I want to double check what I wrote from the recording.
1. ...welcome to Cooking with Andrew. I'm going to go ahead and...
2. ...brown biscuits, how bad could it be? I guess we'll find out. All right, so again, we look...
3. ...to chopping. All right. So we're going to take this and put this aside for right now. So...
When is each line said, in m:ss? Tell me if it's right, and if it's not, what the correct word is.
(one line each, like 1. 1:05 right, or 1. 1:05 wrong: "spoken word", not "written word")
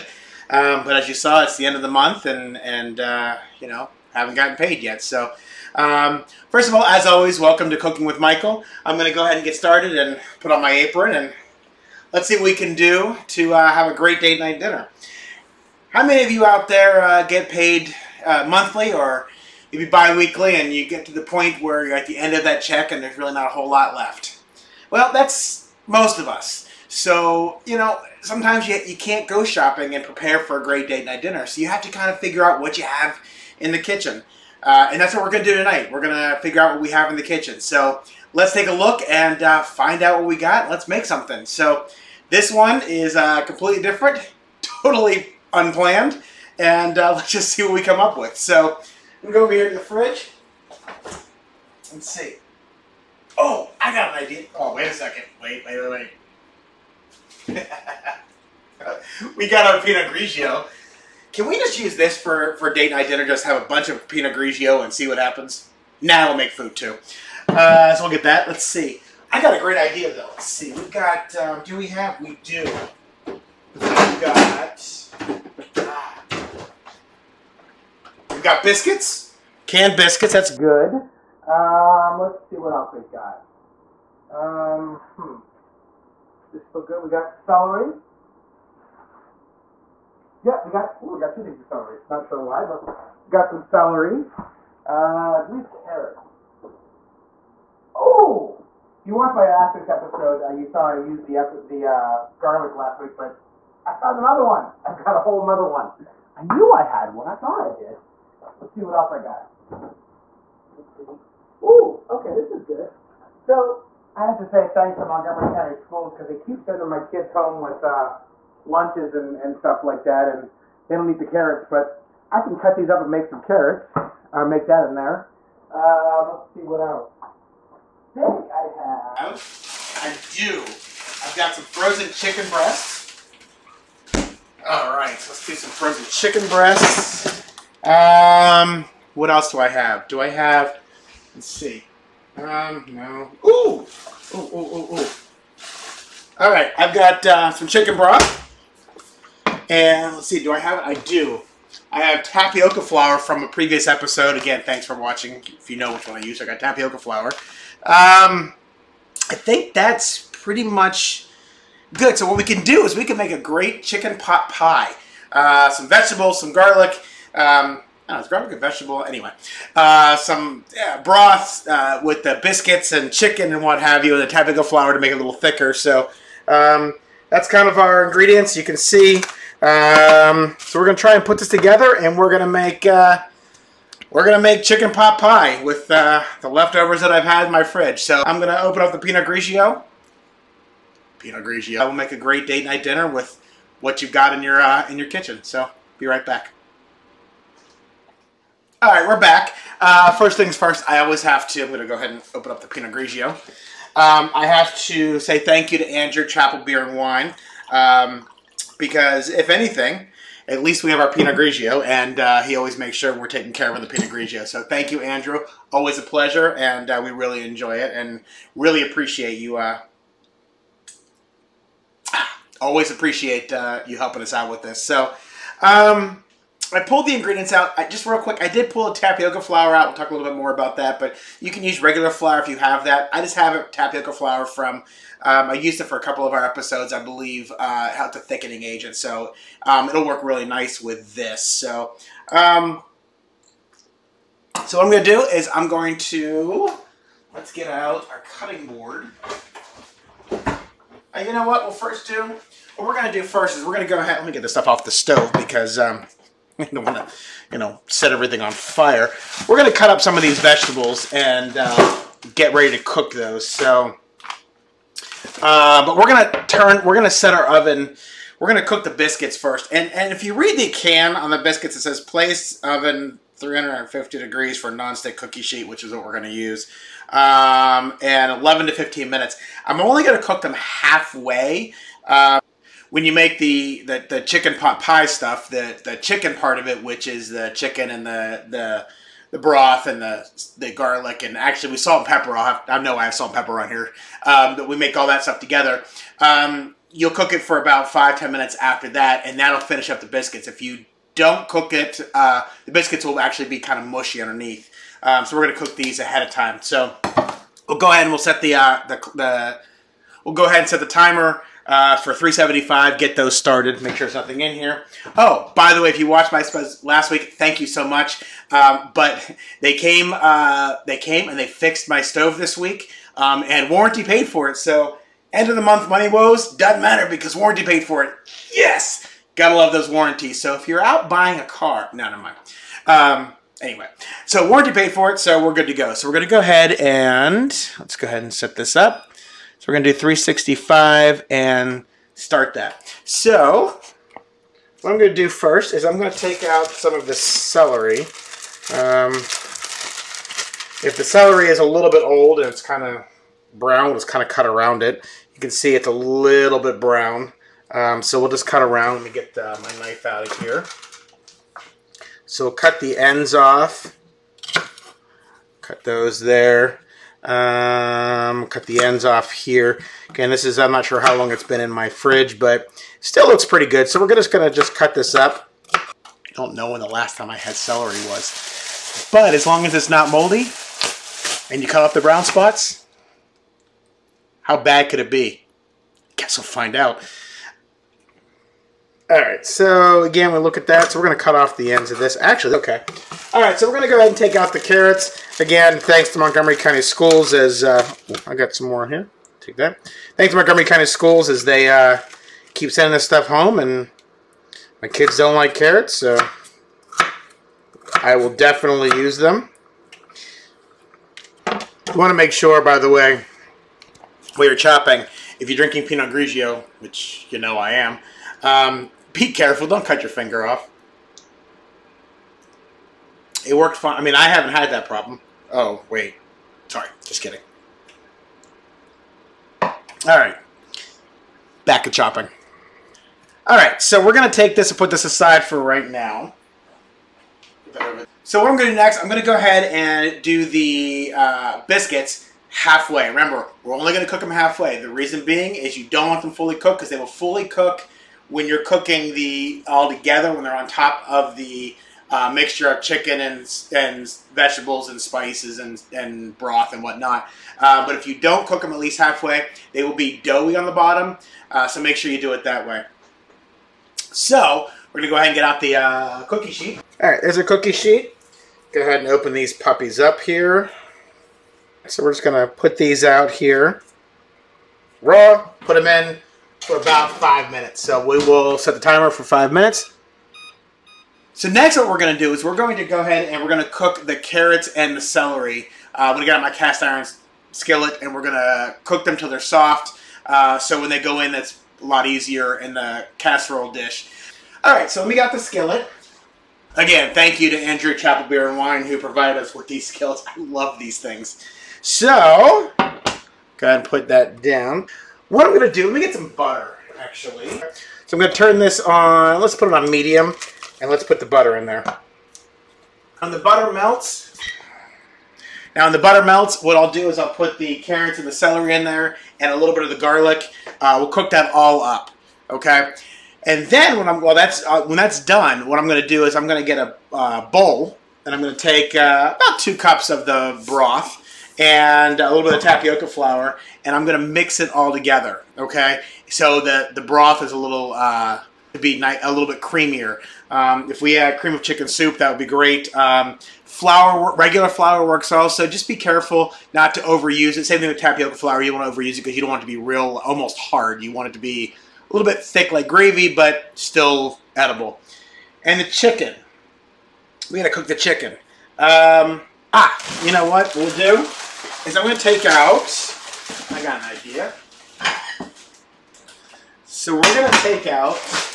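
1. 0:07 wrong: "Michael", not "Andrew"
2. 6:21 wrong: "spots", not "biscuits"
3. 7:11 right.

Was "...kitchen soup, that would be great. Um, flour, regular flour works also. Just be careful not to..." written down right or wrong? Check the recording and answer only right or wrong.
wrong.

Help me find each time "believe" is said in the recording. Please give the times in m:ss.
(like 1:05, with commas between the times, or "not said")
1:35, 3:57.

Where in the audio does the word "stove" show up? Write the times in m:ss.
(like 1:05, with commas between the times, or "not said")
4:14, 5:22.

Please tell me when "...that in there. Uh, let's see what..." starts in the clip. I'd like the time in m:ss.
2:04.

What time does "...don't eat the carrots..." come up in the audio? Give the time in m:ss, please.
2:00.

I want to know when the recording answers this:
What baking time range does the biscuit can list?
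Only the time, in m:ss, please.
4:38.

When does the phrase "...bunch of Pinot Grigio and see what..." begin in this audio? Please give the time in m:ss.
1:03.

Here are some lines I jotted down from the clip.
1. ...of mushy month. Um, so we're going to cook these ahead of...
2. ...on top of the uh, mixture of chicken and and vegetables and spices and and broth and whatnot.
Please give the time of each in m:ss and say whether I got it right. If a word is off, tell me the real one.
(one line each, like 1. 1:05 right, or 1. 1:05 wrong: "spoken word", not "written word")
1. 5:03 wrong: "underneath", not "month"
2. 7:30 right.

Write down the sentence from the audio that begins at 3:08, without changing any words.
So I'm gonna open up the Pinot Grigio.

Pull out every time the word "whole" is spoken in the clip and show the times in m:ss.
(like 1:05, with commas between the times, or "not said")
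0:23, 1:45.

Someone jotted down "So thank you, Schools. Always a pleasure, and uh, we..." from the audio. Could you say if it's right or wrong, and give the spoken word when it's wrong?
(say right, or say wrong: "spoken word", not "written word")
wrong: "Andrew", not "Schools".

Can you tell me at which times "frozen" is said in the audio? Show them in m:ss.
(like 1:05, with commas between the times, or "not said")
2:11, 2:15.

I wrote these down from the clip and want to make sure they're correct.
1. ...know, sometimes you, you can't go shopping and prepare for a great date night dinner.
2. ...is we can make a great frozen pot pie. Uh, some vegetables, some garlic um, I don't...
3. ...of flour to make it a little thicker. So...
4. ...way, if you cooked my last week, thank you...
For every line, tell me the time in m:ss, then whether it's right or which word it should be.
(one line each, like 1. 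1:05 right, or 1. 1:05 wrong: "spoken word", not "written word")
1. 0:27 right
2. 2:42 wrong: "chicken", not "frozen"
3. 2:54 right
4. 5:15 wrong: "watched", not "cooked".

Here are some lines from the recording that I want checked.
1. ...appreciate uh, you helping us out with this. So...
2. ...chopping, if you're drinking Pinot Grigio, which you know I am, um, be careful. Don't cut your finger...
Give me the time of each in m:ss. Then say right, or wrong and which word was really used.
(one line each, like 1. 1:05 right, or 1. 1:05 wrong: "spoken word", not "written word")
1. 3:42 right
2. 6:54 right.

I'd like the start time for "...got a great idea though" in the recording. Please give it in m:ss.
1:09.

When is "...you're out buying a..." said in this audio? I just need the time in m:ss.
5:30.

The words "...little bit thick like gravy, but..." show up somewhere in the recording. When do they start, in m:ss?
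9:12.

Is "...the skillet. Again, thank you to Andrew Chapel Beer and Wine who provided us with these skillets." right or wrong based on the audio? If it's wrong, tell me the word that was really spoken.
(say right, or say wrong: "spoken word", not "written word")
right.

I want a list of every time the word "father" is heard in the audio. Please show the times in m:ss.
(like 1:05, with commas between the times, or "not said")
not said.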